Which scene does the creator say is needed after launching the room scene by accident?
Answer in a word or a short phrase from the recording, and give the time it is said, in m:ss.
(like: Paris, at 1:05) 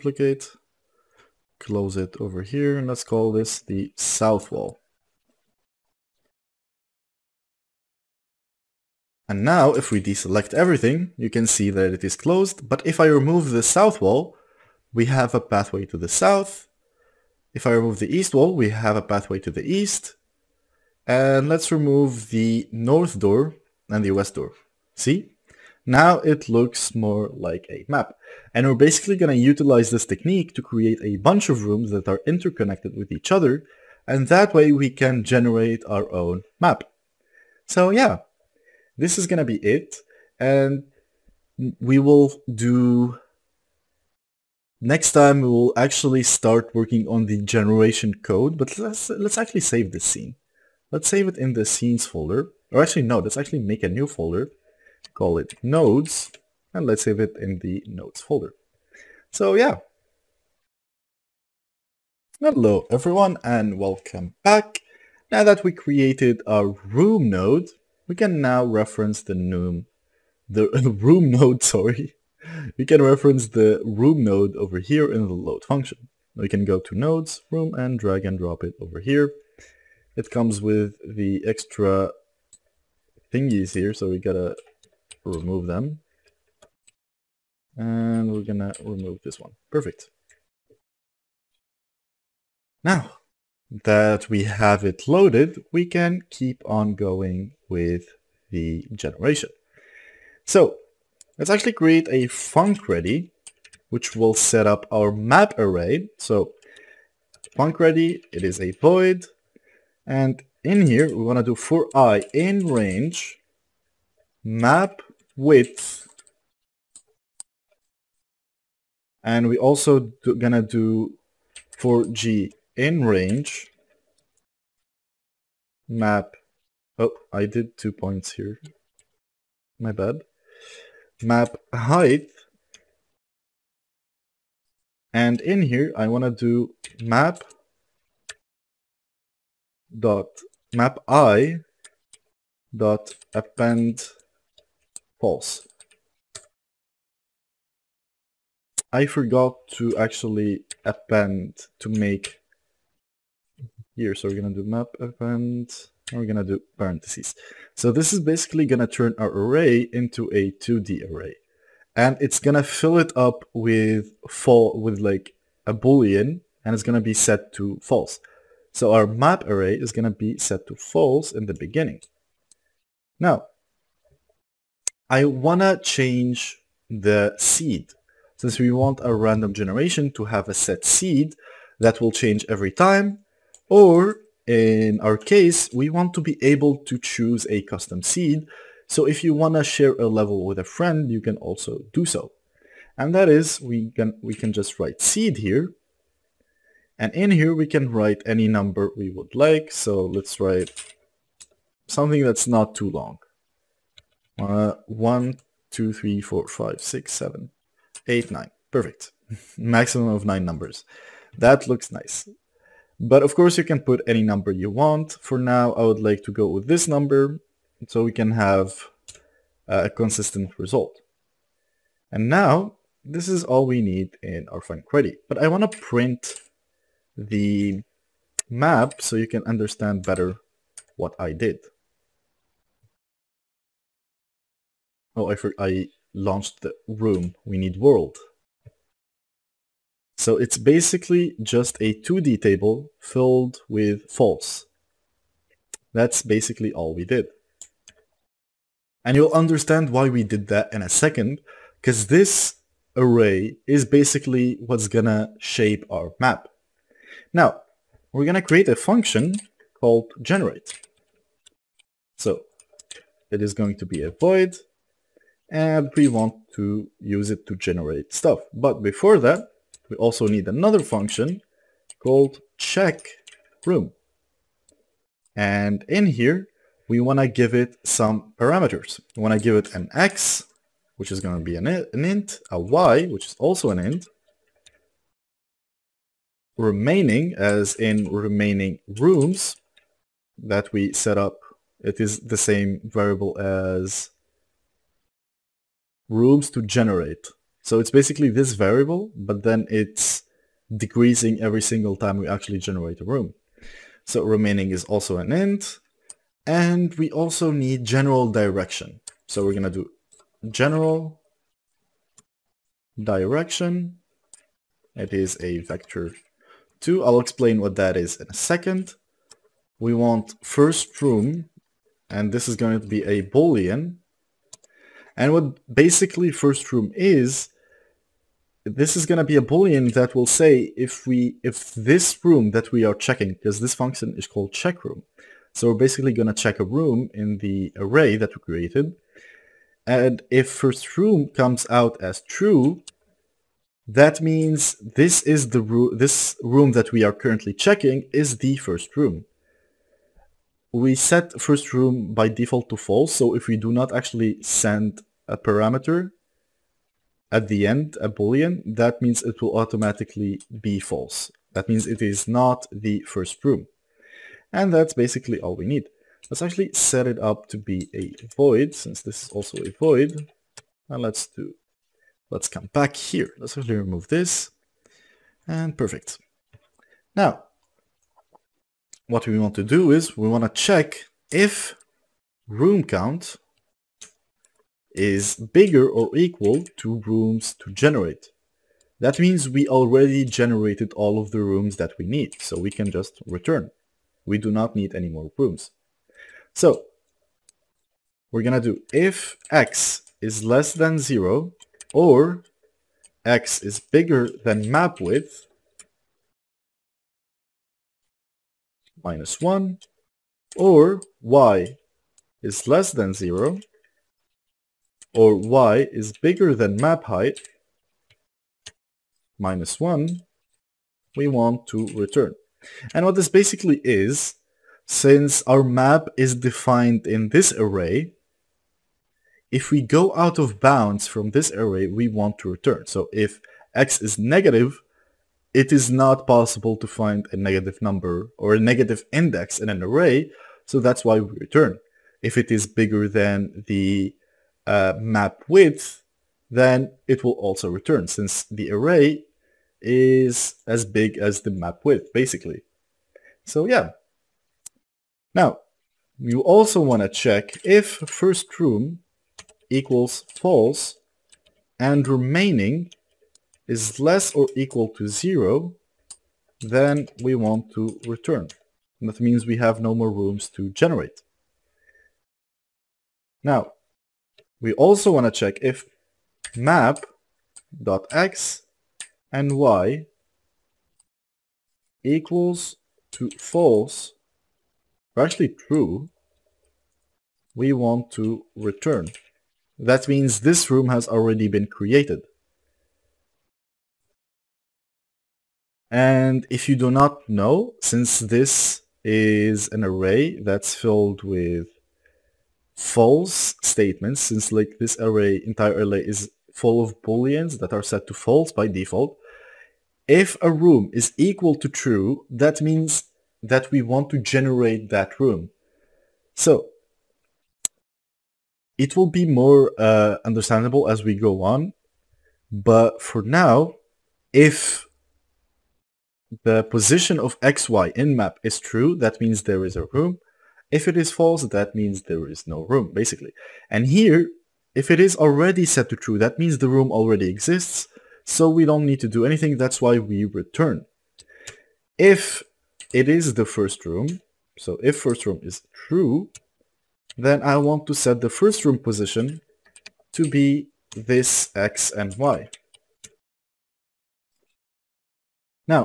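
world, at 3:57.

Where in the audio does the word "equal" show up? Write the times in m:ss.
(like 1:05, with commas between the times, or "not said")
6:26, 7:39, 7:44, 8:02, 8:31.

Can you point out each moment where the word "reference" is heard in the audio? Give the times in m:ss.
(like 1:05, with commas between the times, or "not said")
1:08, 1:13.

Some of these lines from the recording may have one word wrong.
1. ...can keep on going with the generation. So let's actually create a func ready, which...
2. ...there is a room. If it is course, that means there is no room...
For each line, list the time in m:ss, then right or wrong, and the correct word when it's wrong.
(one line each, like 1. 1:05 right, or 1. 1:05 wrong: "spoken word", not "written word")
1. 1:35 right
2. 8:49 wrong: "false", not "course".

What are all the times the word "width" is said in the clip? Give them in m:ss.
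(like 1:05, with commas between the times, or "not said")
1:55, 6:44, 7:25, 7:31.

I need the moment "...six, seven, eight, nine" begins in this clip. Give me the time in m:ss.
3:26.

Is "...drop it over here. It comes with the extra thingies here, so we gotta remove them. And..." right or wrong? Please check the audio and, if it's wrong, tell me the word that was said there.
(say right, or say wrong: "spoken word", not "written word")
right.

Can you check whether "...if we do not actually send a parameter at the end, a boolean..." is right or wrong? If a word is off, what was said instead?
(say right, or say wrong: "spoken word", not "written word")
right.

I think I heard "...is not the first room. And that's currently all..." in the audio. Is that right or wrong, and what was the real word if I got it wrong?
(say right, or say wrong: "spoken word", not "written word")
wrong: "basically", not "currently".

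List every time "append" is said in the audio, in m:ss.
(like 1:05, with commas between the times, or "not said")
2:23, 2:30, 2:34.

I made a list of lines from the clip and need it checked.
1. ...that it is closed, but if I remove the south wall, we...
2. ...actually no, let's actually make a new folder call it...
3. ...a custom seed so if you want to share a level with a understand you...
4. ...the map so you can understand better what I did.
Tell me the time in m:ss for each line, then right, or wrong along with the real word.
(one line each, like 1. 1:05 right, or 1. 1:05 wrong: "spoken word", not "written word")
1. 0:11 right
2. 0:52 right
3. 3:07 wrong: "friend", not "understand"
4. 3:47 right.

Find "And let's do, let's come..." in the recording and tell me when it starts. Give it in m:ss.
6:10.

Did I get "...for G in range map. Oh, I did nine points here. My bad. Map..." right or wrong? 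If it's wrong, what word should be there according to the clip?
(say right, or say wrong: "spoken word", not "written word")
wrong: "two", not "nine".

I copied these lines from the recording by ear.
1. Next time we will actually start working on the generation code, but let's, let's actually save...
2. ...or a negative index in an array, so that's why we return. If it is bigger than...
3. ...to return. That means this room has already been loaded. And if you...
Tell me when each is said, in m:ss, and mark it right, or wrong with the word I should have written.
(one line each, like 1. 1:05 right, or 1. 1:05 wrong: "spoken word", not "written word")
1. 0:44 right
2. 7:18 right
3. 8:08 wrong: "created", not "loaded".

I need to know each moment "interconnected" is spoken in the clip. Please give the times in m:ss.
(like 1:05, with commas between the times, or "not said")
0:32.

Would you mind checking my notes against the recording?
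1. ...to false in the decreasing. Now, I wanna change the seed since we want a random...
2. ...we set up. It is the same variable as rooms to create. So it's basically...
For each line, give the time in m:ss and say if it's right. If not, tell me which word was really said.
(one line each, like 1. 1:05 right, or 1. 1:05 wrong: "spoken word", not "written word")
1. 2:50 wrong: "beginning", not "decreasing"
2. 4:50 wrong: "generate", not "create".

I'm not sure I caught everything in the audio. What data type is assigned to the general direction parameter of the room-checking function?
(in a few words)
vector 2.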